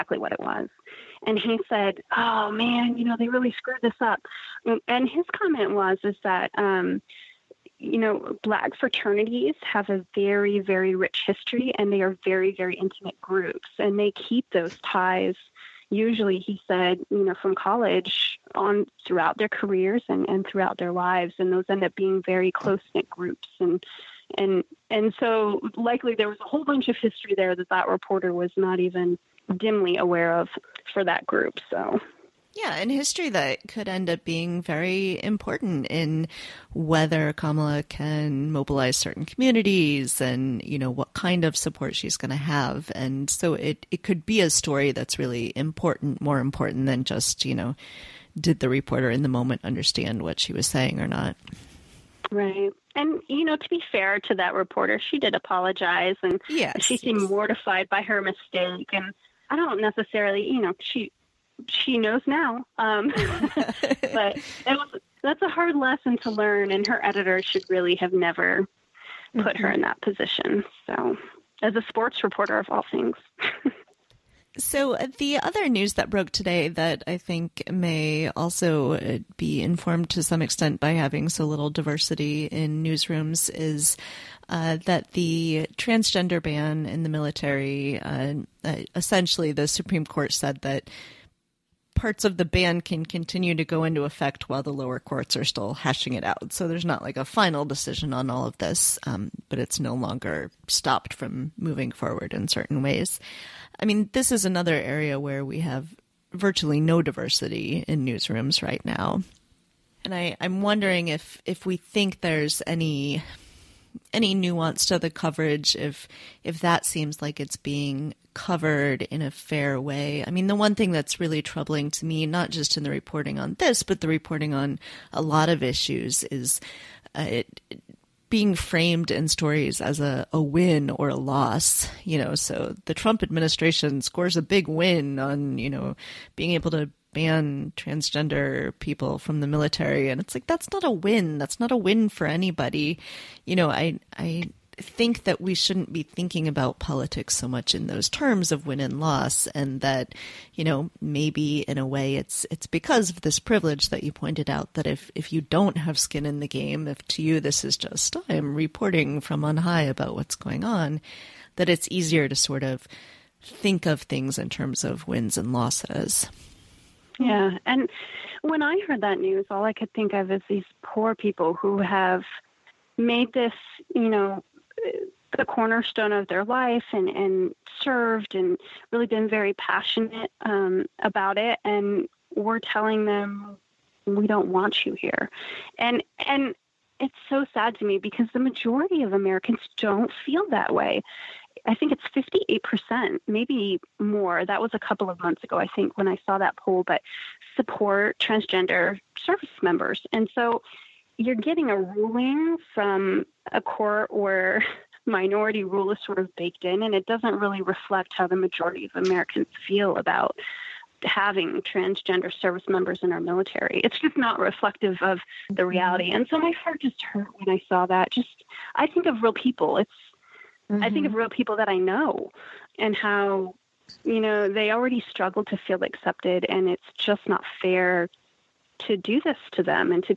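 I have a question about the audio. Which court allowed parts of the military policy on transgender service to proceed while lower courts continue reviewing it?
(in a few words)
The Supreme Court.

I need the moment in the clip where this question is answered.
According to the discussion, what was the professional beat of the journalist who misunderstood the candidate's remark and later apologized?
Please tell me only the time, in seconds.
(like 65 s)
71 s.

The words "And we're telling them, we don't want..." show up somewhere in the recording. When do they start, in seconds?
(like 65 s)
181 s.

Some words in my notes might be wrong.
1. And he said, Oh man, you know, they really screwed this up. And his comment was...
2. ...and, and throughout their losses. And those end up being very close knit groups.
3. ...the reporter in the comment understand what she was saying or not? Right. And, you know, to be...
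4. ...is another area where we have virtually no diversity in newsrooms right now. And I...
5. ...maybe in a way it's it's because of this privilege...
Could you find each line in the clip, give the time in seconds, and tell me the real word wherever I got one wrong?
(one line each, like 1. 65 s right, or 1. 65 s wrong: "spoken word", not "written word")
1. 1 s right
2. 20 s wrong: "lives", not "losses"
3. 48 s wrong: "moment", not "comment"
4. 104 s right
5. 150 s right.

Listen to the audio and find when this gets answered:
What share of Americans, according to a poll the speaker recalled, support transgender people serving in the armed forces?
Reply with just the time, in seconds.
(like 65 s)
192 s.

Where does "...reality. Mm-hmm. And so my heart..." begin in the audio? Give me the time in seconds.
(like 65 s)
215 s.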